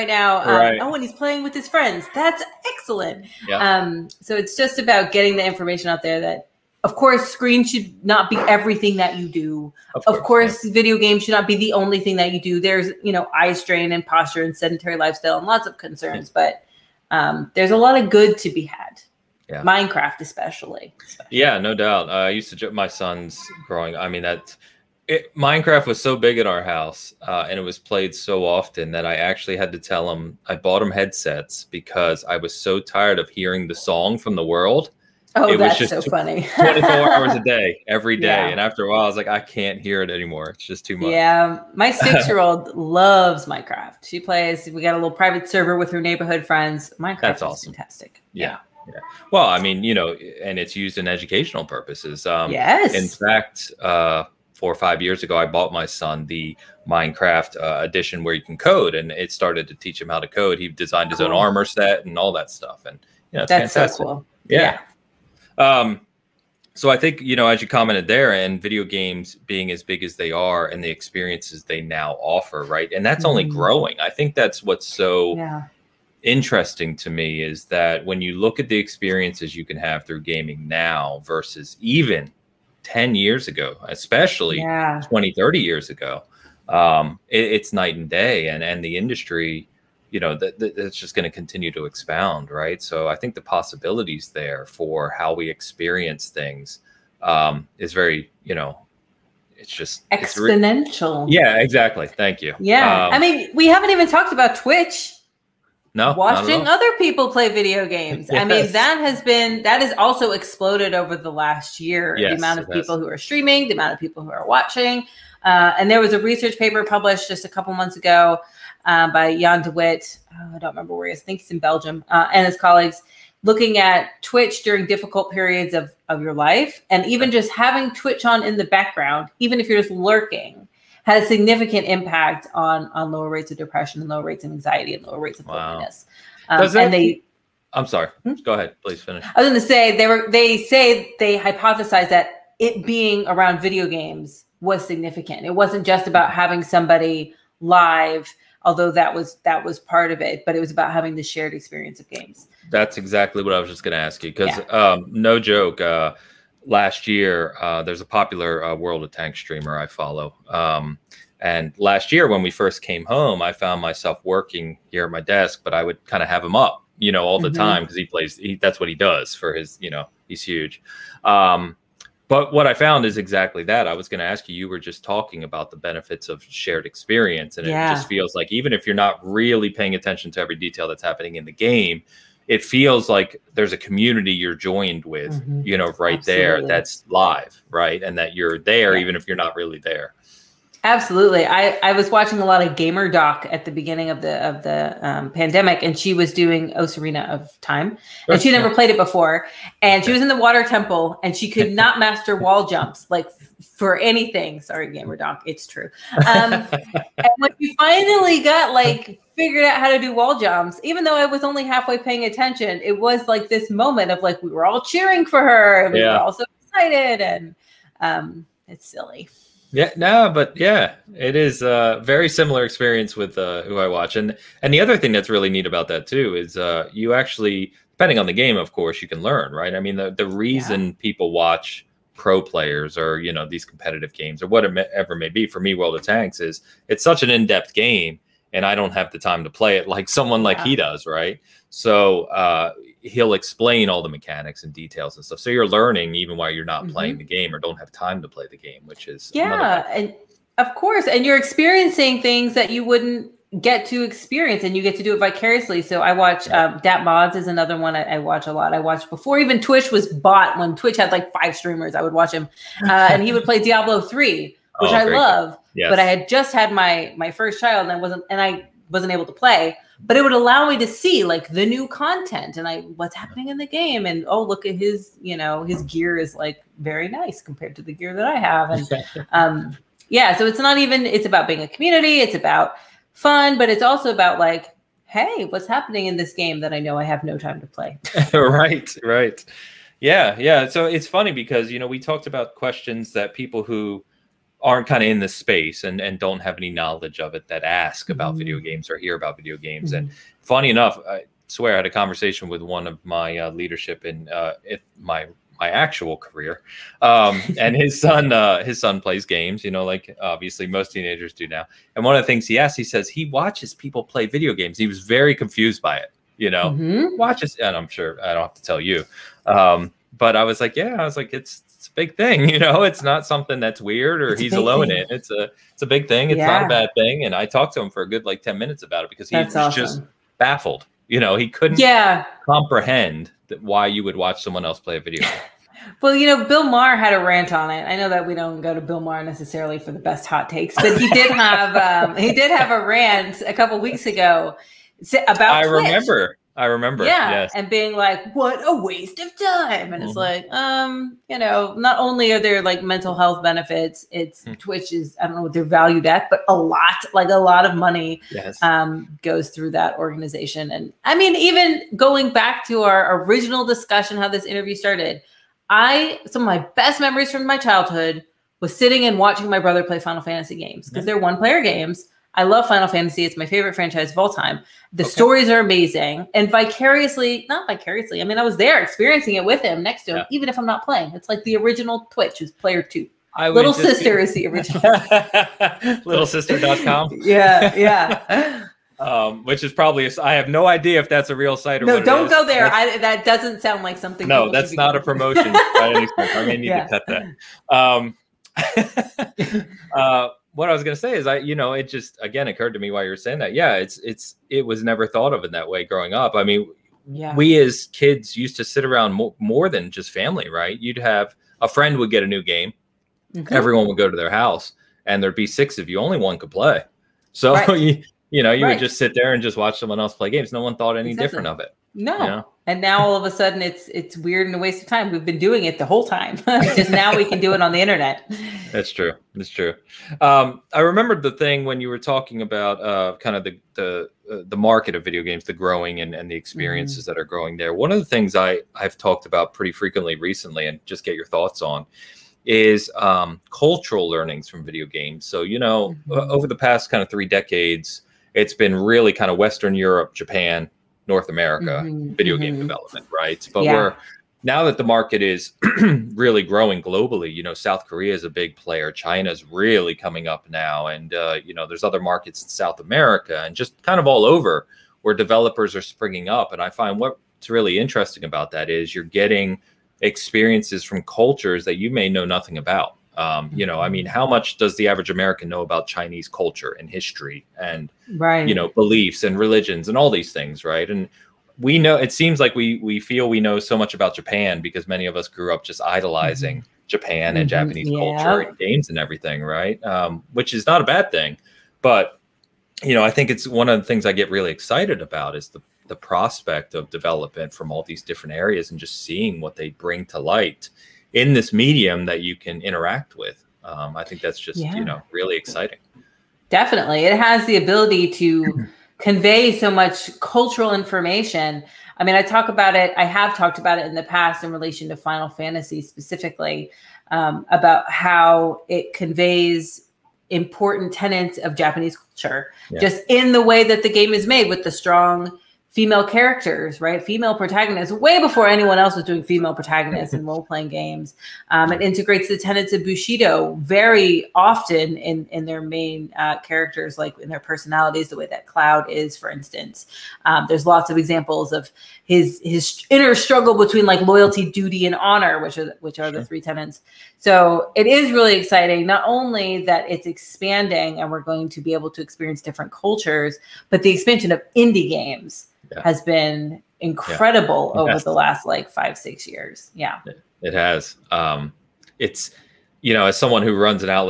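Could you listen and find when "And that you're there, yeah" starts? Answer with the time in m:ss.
3:08.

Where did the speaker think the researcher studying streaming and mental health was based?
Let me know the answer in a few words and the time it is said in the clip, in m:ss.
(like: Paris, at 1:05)
Belgium, at 2:01.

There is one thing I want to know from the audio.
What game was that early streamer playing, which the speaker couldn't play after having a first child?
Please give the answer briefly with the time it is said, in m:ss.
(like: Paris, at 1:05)
Diablo 3, at 4:23.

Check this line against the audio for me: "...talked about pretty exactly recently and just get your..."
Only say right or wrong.
wrong.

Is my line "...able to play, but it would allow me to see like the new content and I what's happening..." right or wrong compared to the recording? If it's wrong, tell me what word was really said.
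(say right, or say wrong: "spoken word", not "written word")
right.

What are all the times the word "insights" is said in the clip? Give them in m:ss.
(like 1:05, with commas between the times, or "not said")
not said.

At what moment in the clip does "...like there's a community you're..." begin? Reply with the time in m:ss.
3:03.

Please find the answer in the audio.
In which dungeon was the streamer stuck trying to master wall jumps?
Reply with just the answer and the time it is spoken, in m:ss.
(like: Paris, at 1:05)
Water Temple, at 3:20.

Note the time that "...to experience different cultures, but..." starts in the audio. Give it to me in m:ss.
9:11.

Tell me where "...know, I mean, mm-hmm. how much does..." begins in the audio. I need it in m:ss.
7:53.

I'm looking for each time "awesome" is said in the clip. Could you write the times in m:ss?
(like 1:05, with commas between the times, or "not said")
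0:47, 5:29.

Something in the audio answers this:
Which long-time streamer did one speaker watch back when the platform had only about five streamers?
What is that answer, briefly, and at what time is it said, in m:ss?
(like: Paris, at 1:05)
DatModz, at 4:16.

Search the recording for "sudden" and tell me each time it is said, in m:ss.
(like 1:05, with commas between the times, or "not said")
7:03.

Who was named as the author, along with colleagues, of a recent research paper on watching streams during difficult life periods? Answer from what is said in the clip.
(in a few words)
Jan de Wit.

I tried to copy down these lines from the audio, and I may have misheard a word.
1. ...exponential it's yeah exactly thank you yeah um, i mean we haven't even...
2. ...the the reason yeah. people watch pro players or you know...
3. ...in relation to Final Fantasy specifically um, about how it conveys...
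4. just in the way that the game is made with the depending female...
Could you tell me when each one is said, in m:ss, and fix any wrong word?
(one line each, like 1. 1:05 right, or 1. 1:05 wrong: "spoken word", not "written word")
1. 1:40 right
2. 3:49 right
3. 8:34 right
4. 8:42 wrong: "strong", not "depending".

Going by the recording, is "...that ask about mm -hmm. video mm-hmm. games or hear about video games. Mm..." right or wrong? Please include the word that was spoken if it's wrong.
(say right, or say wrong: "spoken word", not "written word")
right.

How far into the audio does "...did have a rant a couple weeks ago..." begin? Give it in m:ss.
5:42.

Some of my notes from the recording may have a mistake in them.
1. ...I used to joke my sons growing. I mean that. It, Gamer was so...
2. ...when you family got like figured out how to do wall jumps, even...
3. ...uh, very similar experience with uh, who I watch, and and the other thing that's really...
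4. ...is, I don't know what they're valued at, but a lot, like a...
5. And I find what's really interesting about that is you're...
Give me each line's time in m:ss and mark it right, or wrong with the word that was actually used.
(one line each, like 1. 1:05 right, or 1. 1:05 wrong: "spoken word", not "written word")
1. 0:22 wrong: "Minecraft", not "Gamer"
2. 3:27 wrong: "finally", not "family"
3. 3:41 right
4. 5:54 right
5. 7:46 right.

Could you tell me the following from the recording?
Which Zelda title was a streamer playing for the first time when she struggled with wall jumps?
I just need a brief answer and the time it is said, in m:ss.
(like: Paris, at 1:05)
Ocarina of Time, at 3:16.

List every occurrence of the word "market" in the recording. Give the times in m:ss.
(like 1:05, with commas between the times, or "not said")
7:14, 7:34, 7:41.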